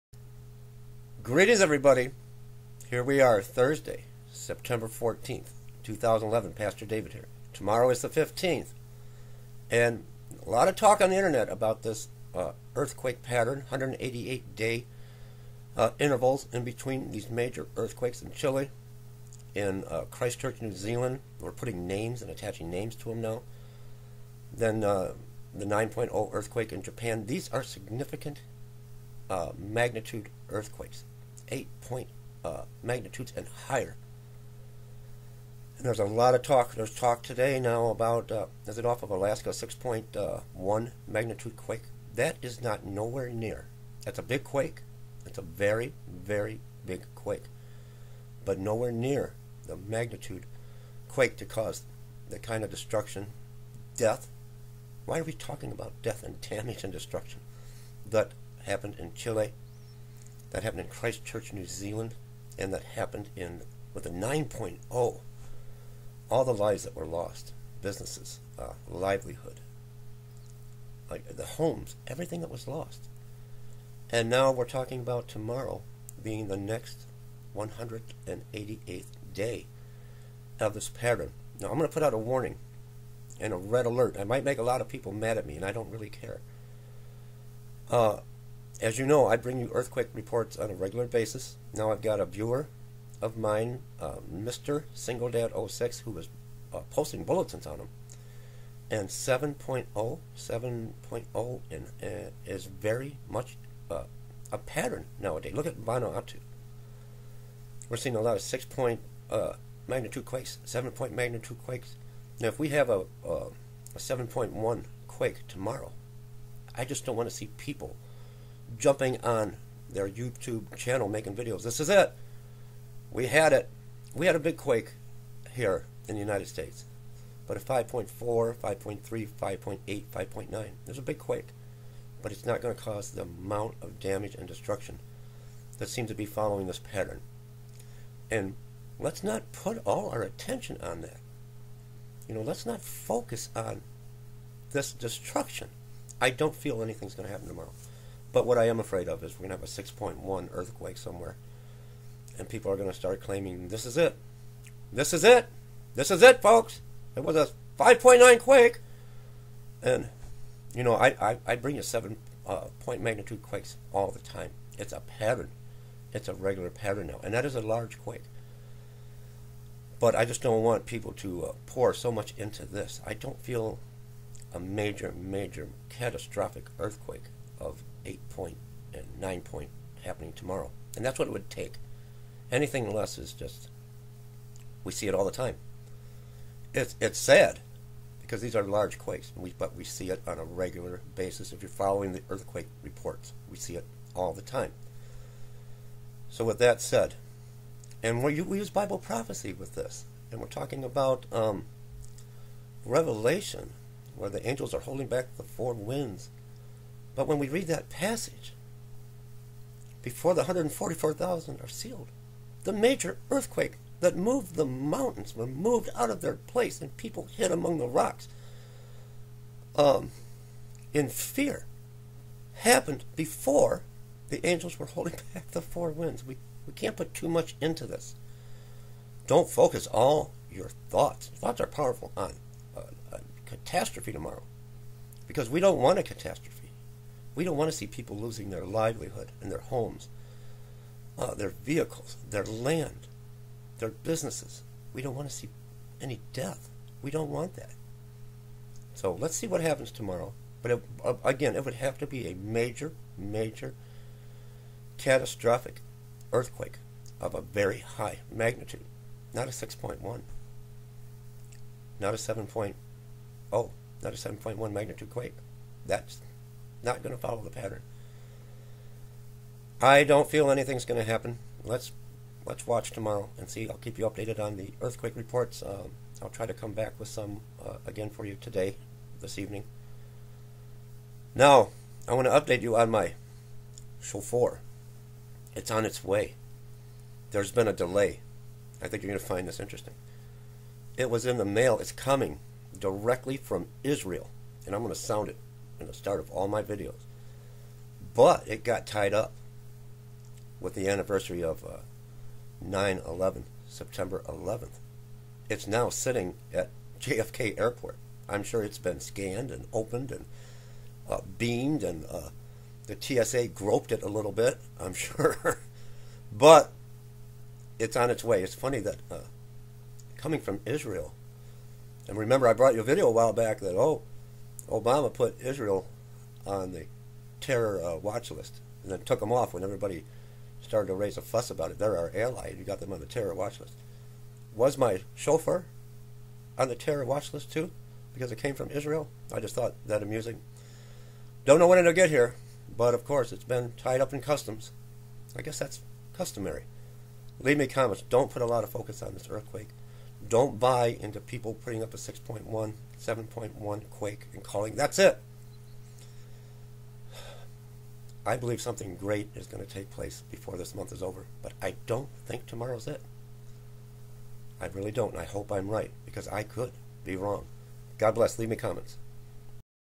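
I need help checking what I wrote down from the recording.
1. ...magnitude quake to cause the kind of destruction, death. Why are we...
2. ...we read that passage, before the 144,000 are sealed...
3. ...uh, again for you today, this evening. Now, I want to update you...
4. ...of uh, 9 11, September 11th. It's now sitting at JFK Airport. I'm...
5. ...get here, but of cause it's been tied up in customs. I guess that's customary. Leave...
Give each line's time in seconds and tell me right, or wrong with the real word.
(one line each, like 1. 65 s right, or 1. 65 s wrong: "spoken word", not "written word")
1. 49 s right
2. 207 s right
3. 277 s right
4. 301 s right
5. 341 s wrong: "course", not "cause".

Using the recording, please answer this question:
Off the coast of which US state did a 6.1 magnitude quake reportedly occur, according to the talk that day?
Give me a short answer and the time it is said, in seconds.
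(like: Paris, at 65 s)
Alaska, at 39 s.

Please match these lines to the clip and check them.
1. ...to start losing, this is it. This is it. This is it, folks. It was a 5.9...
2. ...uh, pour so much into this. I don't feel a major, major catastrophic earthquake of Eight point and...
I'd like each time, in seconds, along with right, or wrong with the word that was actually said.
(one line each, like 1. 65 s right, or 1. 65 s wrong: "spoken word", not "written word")
1. 152 s wrong: "claiming", not "losing"
2. 171 s right.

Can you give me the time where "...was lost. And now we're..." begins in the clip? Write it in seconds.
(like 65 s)
72 s.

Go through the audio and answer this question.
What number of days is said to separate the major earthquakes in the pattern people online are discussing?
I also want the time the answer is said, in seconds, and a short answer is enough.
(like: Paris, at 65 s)
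188, at 13 s.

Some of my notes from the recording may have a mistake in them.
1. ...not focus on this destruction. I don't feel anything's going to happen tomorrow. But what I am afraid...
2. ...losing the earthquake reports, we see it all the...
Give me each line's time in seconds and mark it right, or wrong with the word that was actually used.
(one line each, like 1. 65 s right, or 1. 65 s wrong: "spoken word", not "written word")
1. 142 s right
2. 191 s wrong: "following", not "losing".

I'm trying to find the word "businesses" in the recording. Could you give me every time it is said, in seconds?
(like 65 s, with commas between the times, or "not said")
67 s, 243 s.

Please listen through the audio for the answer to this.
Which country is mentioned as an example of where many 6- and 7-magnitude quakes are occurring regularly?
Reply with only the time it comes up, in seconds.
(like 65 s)
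105 s.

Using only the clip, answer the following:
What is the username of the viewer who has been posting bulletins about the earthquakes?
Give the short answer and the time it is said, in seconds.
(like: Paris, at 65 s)
singledad 06, at 94 s.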